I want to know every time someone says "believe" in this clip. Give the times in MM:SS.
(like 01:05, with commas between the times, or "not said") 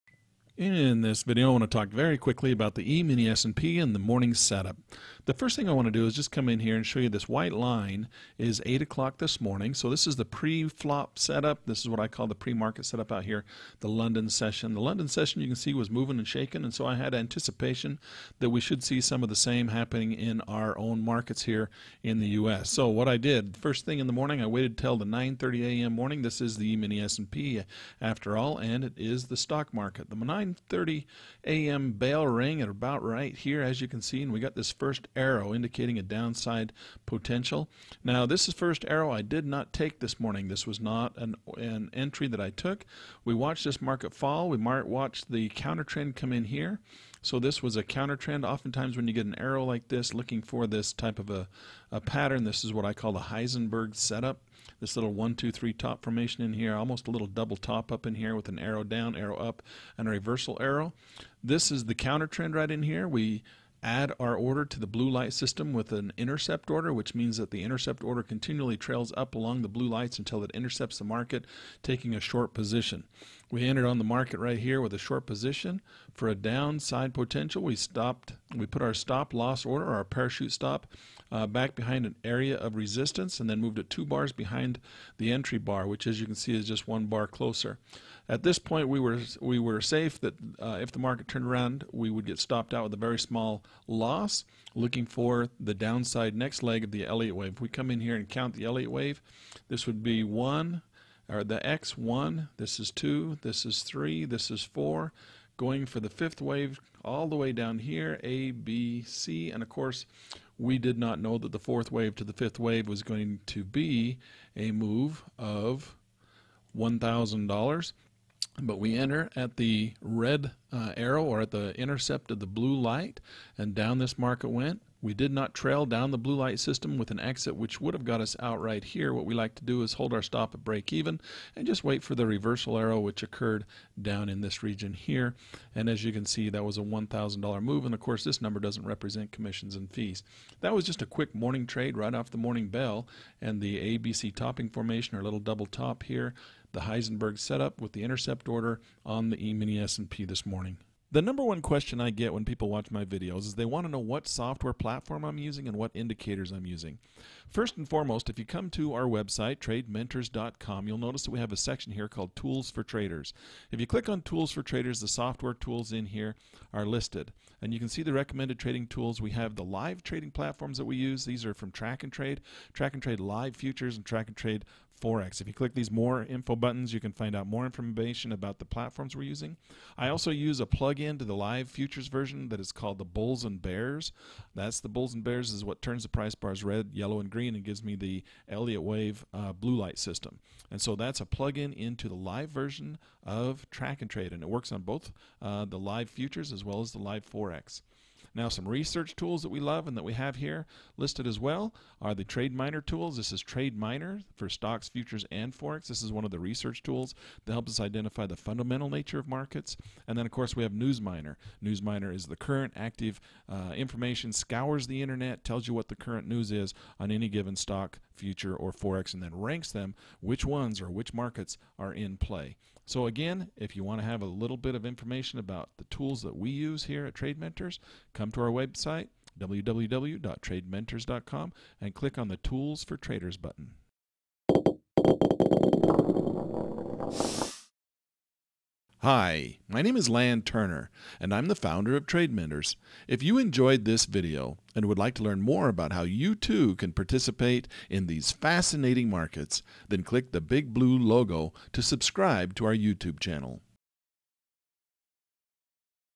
not said.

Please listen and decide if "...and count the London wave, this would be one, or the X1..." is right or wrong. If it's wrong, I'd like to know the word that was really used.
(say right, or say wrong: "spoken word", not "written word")
wrong: "Elliott", not "London".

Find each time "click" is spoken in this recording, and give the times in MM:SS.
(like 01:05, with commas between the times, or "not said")
02:43, 02:55, 03:51, 04:10.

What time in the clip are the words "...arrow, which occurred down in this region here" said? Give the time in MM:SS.
02:12.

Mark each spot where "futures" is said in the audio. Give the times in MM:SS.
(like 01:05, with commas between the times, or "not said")
02:53, 03:01, 03:16, 03:24, 03:38.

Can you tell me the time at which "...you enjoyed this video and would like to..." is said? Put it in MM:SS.
04:03.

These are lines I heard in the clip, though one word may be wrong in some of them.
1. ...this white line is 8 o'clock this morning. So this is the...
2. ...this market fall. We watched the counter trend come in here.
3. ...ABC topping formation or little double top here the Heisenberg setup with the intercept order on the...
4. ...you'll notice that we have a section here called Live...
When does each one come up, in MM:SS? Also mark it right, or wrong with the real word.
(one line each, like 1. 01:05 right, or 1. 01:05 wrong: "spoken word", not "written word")
1. 00:07 right
2. 00:43 right
3. 02:23 right
4. 02:40 wrong: "Tools", not "Live".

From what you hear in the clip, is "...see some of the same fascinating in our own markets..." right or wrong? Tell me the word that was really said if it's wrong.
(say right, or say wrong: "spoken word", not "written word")
wrong: "happening", not "fascinating".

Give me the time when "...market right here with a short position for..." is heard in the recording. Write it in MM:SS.
01:14.